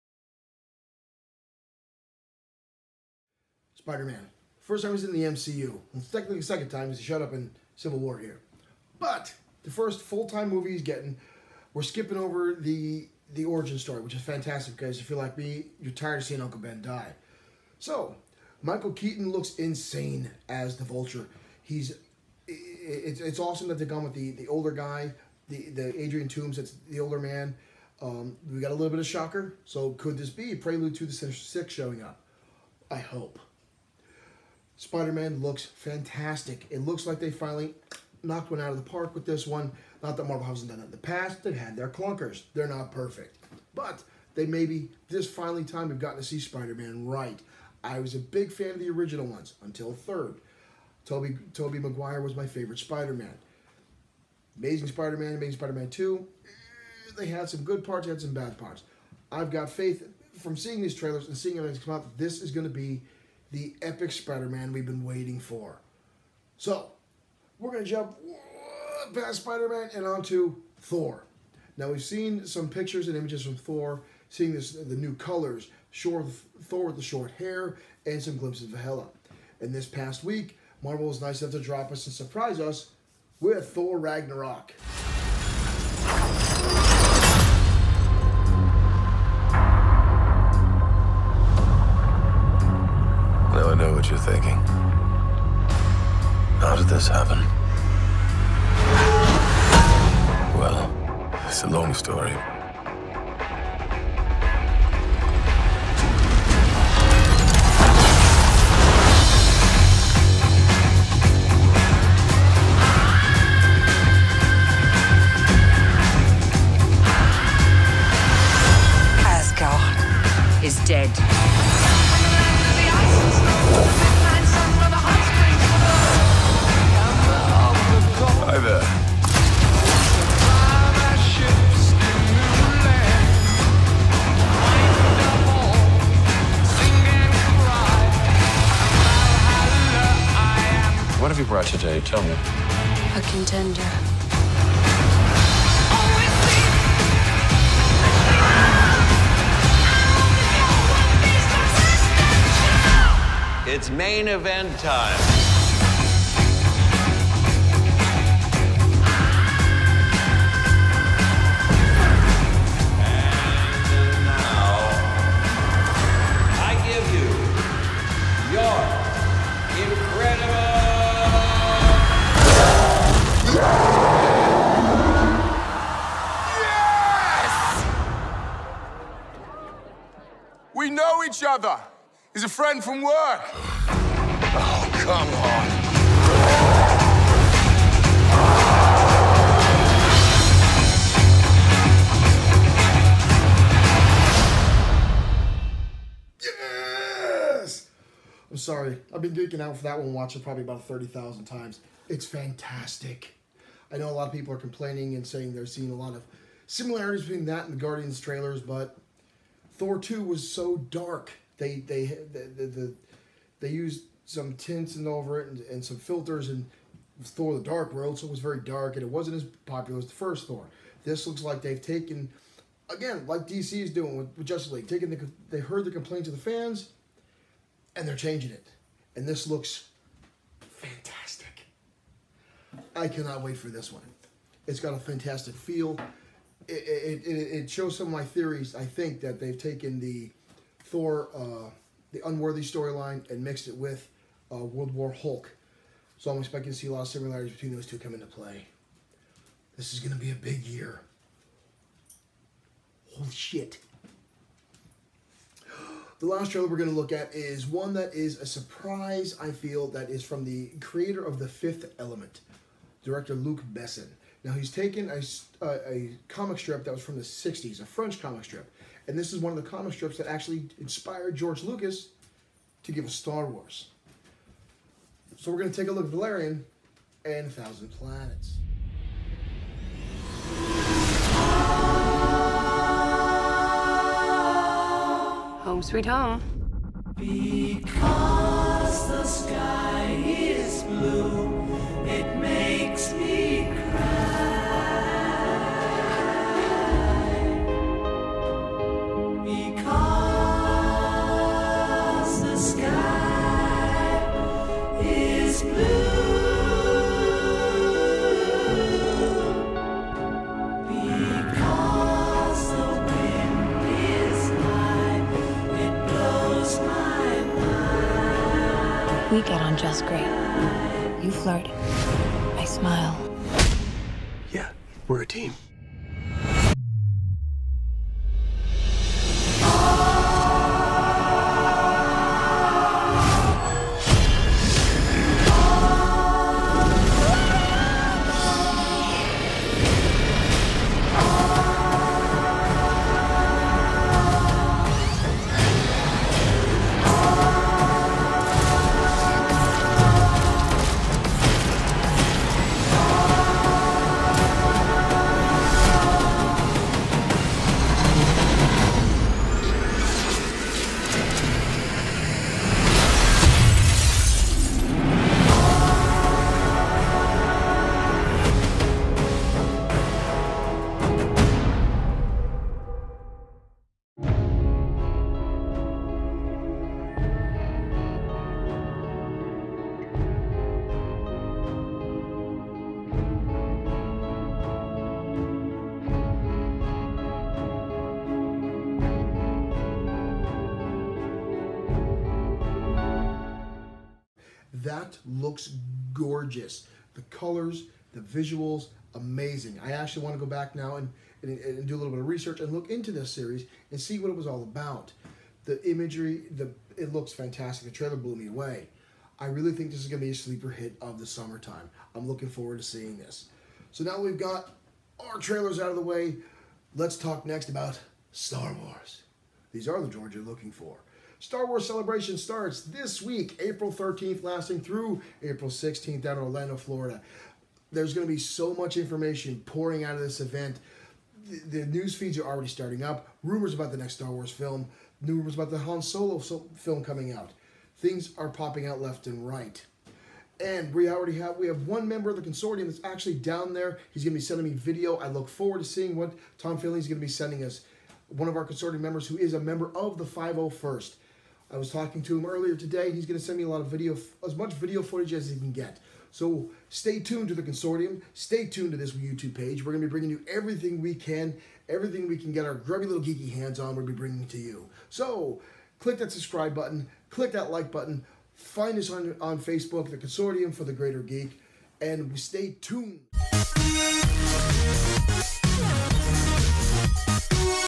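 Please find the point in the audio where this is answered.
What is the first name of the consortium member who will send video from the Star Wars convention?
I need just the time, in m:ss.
7:26.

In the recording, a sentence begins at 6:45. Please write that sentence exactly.
The imagery, the it looks fantastic.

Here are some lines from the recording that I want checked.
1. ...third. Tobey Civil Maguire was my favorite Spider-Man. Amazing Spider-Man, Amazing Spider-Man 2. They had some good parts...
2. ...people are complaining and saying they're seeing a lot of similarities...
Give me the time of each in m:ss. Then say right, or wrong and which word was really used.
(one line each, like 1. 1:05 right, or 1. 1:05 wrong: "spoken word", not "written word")
1. 0:49 wrong: "Tobey", not "Civil"
2. 3:24 right.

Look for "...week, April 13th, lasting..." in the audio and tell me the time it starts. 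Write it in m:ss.
7:03.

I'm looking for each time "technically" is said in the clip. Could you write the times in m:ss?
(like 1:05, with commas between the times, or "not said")
0:06.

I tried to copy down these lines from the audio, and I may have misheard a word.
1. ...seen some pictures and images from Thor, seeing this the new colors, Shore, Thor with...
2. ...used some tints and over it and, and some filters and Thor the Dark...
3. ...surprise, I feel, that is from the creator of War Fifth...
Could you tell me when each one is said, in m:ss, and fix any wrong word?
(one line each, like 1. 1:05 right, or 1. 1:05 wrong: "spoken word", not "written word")
1. 1:12 right
2. 3:33 right
3. 4:18 wrong: "The", not "War".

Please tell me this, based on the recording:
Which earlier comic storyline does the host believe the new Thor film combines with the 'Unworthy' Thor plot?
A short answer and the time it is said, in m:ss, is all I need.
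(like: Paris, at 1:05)
World War Hulk, at 4:04.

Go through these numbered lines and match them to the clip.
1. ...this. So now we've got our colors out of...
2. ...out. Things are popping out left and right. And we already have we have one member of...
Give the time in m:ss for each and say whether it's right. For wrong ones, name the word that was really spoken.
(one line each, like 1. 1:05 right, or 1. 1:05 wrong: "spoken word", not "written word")
1. 6:53 wrong: "trailers", not "colors"
2. 7:17 right.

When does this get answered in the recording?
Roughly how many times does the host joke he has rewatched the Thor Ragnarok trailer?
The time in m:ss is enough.
3:20.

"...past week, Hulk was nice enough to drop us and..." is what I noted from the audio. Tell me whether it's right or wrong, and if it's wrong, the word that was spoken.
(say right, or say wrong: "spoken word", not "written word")
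wrong: "Marvel", not "Hulk".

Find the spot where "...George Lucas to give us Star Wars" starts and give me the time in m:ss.
4:31.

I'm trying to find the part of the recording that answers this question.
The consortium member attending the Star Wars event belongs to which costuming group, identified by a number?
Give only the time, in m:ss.
7:30.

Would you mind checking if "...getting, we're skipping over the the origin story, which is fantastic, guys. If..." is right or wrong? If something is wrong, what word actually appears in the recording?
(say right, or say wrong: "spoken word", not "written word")
right.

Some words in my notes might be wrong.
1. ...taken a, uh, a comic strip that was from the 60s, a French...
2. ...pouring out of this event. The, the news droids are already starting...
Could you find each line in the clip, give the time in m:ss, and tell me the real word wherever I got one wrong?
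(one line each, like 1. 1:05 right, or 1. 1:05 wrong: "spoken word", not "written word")
1. 4:24 right
2. 7:09 wrong: "feeds", not "droids".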